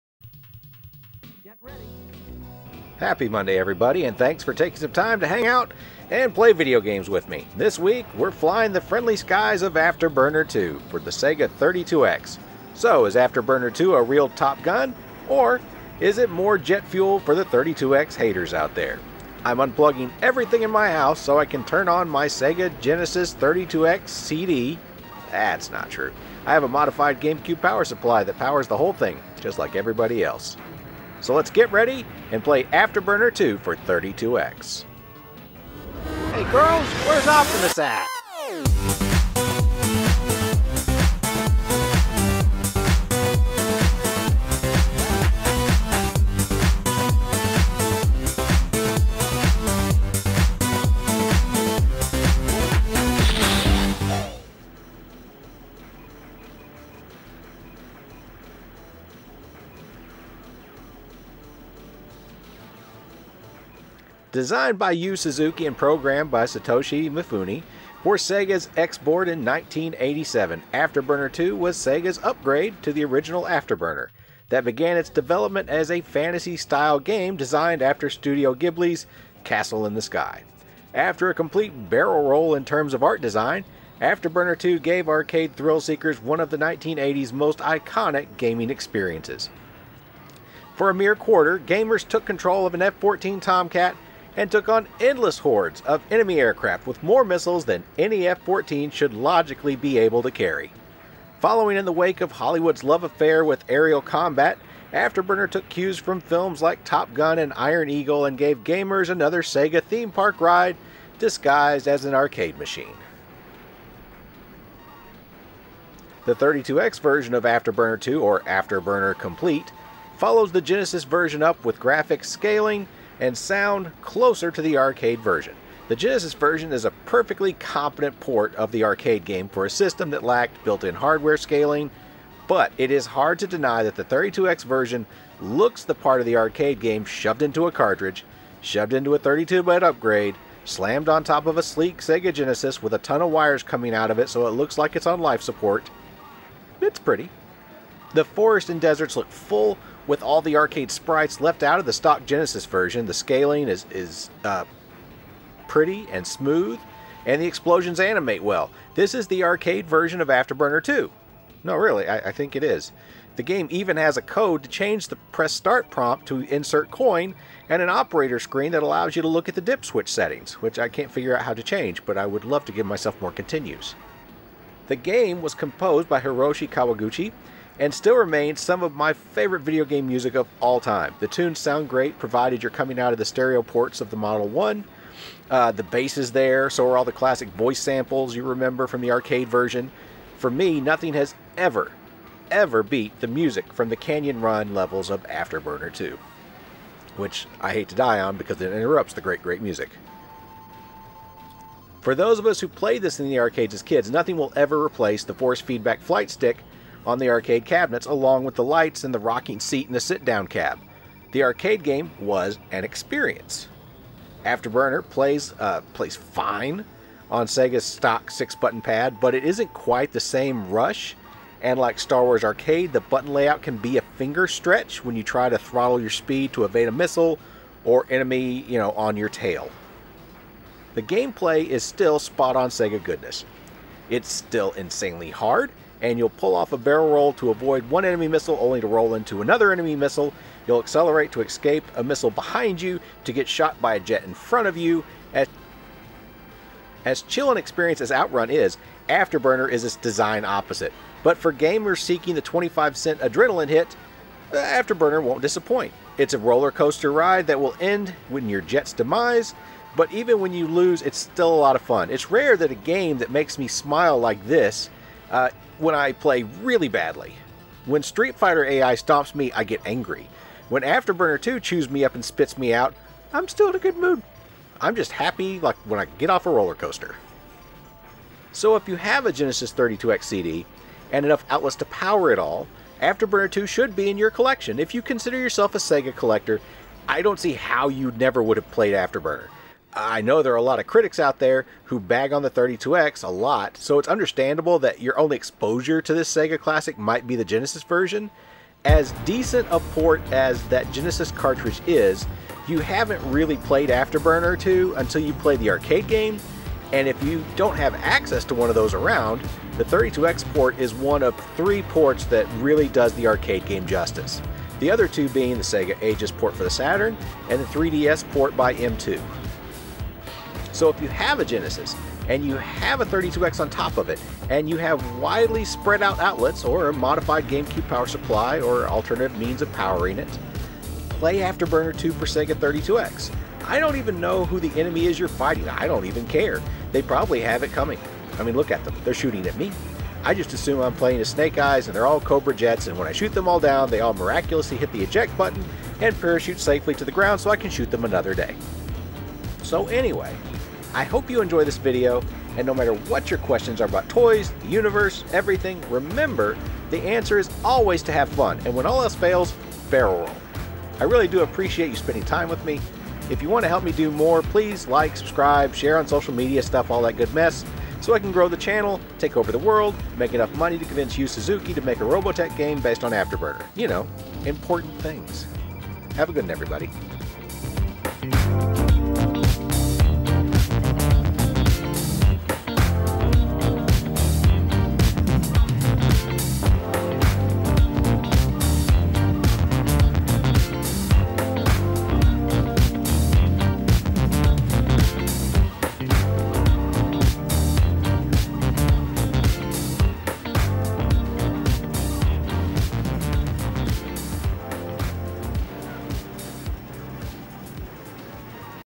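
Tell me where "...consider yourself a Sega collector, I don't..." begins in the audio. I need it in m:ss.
4:45.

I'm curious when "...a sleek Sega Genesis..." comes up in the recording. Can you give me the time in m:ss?
2:21.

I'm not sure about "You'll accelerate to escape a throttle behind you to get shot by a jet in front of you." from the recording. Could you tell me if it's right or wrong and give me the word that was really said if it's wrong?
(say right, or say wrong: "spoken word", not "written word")
wrong: "missile", not "throttle".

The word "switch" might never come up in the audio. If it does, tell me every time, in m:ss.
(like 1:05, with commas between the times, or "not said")
2:49.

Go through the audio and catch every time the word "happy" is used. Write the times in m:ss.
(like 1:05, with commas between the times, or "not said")
0:02, 4:35.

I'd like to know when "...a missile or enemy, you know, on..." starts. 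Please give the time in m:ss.
3:46.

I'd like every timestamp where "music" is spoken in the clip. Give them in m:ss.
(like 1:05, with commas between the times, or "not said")
3:00, 3:13, 3:19.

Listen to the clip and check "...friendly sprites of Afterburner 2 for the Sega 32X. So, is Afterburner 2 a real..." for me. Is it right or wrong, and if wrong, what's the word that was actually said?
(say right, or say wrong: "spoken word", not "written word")
wrong: "skies", not "sprites".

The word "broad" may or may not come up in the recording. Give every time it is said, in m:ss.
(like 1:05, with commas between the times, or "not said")
not said.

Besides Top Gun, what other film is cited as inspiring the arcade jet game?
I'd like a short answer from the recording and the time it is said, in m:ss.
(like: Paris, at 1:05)
Iron Eagle, at 1:47.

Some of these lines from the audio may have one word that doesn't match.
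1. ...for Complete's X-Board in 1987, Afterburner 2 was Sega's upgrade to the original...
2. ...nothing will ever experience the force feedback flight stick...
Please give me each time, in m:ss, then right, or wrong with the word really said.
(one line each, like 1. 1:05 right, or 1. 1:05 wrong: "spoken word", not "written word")
1. 1:08 wrong: "Sega", not "Complete"
2. 3:24 wrong: "replace", not "experience".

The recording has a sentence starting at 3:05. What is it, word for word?
Uh, the bass is there, so are all the classic voice samples you remember from the arcade version.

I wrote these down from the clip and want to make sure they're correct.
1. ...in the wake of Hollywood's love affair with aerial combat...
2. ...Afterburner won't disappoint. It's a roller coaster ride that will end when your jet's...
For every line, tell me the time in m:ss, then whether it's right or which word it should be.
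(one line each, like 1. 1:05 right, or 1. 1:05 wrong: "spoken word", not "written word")
1. 1:41 right
2. 4:14 right.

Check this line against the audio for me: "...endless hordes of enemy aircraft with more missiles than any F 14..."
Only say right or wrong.
right.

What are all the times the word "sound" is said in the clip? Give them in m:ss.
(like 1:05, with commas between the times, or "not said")
2:03, 3:01.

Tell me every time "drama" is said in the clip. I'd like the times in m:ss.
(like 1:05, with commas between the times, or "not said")
not said.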